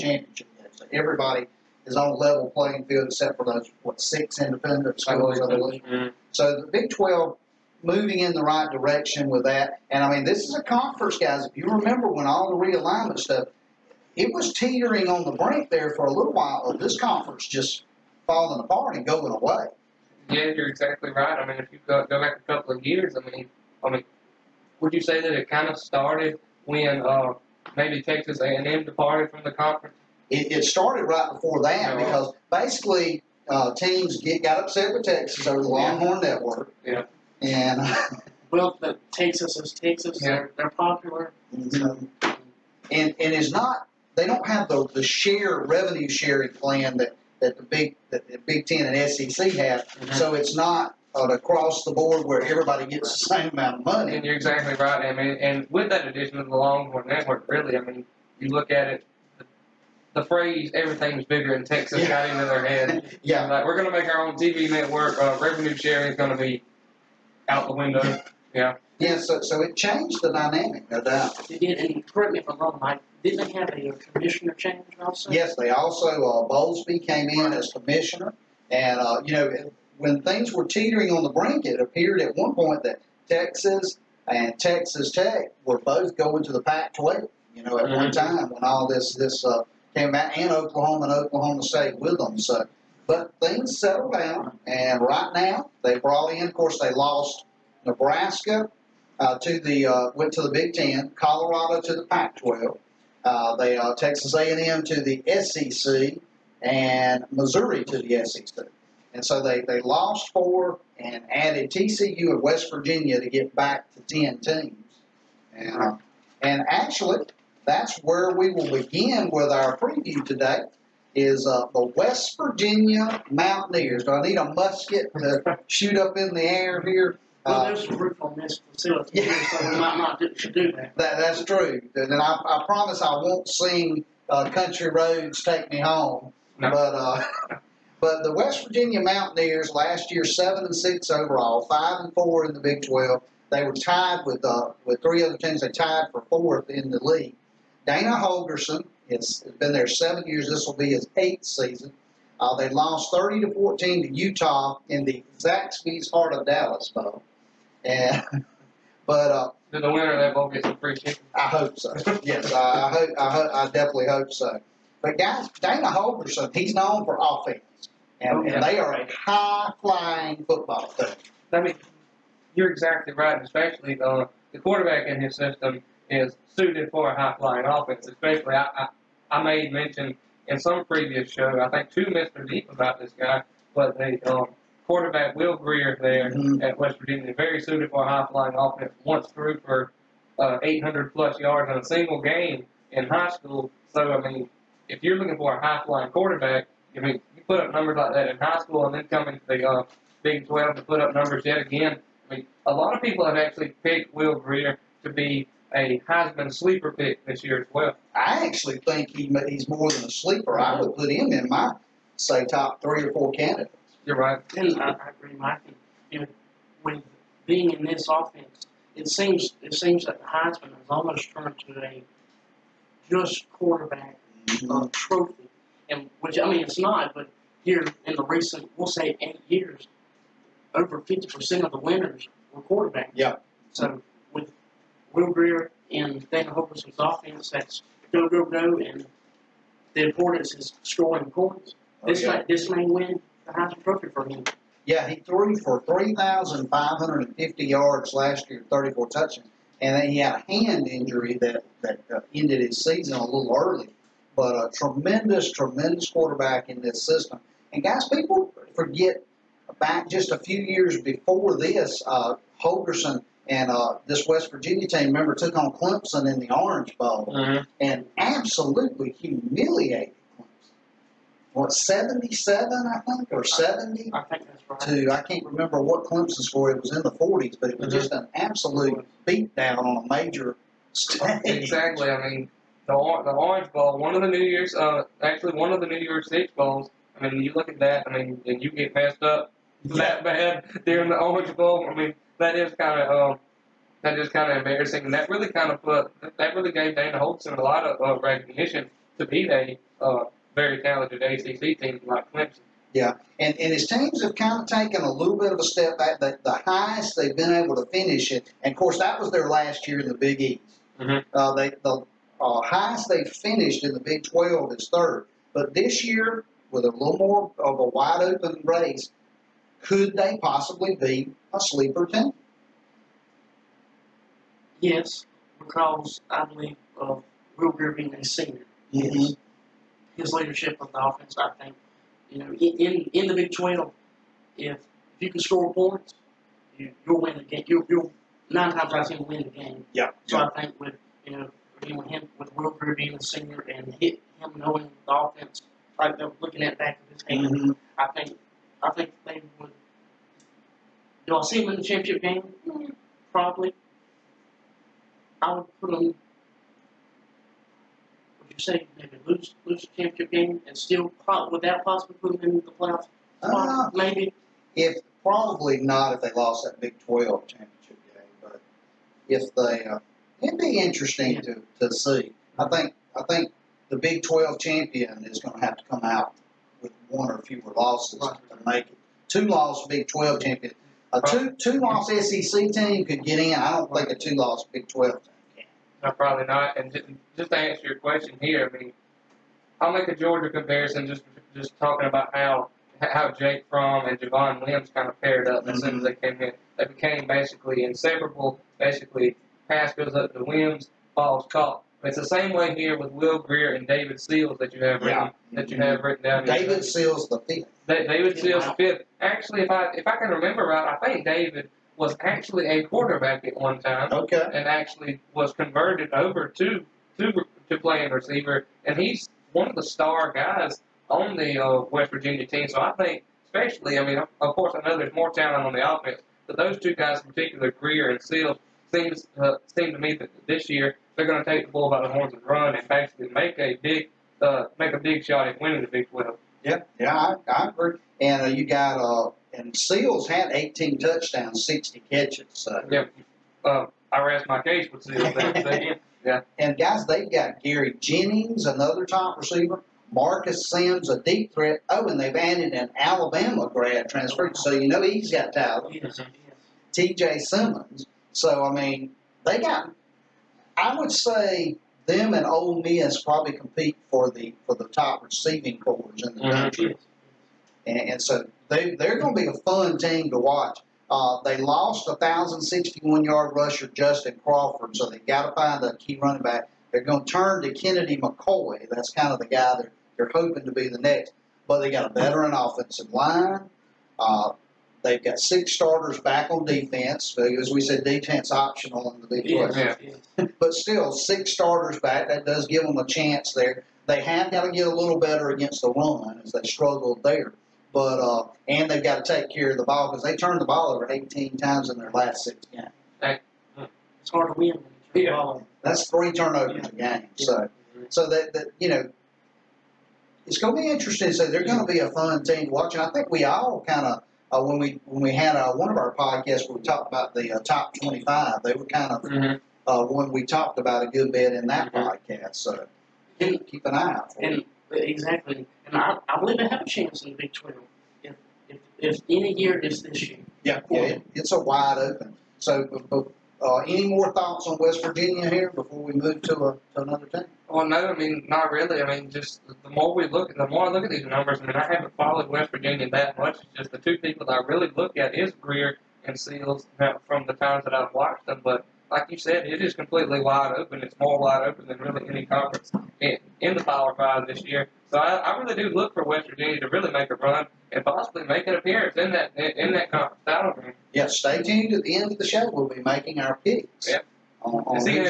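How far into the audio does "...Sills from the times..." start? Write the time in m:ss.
9:06.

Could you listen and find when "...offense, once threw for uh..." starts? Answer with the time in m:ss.
3:08.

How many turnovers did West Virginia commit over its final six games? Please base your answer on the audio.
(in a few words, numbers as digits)
18.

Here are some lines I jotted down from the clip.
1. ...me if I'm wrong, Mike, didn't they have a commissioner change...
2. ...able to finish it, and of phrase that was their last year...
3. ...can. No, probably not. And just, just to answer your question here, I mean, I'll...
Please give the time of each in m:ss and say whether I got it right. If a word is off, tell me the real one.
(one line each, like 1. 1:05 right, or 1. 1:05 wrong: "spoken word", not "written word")
1. 1:12 right
2. 5:07 wrong: "course", not "phrase"
3. 6:25 right.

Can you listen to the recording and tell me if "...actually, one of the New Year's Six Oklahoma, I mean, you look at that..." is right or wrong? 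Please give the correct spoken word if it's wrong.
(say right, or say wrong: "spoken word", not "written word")
wrong: "Bowls", not "Oklahoma".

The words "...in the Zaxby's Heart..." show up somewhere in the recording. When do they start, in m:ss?
2:34.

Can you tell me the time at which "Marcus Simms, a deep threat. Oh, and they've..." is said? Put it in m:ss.
7:30.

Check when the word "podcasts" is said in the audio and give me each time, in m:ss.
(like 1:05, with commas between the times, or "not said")
8:36, 8:42.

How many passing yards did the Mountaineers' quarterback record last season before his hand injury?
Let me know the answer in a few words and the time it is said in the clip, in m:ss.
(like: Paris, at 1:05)
3,550, at 4:05.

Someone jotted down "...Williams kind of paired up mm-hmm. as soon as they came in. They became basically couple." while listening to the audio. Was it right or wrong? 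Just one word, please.
wrong.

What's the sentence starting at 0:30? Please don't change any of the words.
It, it started right before that because basically uh, teams get got upset with Texas over the Longhorn yeah.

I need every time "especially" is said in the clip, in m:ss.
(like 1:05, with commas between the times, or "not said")
2:53, 2:58, 7:03.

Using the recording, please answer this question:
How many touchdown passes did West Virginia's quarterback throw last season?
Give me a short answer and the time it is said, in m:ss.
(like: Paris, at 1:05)
34, at 4:08.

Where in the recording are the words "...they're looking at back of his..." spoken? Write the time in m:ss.
5:46.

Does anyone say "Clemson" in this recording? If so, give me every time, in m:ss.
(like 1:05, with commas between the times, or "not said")
4:25, 4:30, 4:36, 5:02.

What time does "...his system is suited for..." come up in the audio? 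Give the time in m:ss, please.
2:55.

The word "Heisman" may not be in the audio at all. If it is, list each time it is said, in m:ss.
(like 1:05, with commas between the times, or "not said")
3:26, 3:40, 4:03.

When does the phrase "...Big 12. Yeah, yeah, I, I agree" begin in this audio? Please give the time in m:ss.
7:15.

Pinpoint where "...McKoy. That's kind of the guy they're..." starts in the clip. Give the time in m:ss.
7:58.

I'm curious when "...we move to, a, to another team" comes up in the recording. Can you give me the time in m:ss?
8:56.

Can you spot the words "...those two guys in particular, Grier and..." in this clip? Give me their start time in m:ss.
7:06.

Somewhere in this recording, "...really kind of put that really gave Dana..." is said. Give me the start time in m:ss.
4:55.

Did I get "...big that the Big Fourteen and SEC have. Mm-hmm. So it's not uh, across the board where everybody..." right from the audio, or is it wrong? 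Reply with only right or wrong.
wrong.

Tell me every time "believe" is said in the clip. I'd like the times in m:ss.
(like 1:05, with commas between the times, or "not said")
5:26, 8:46.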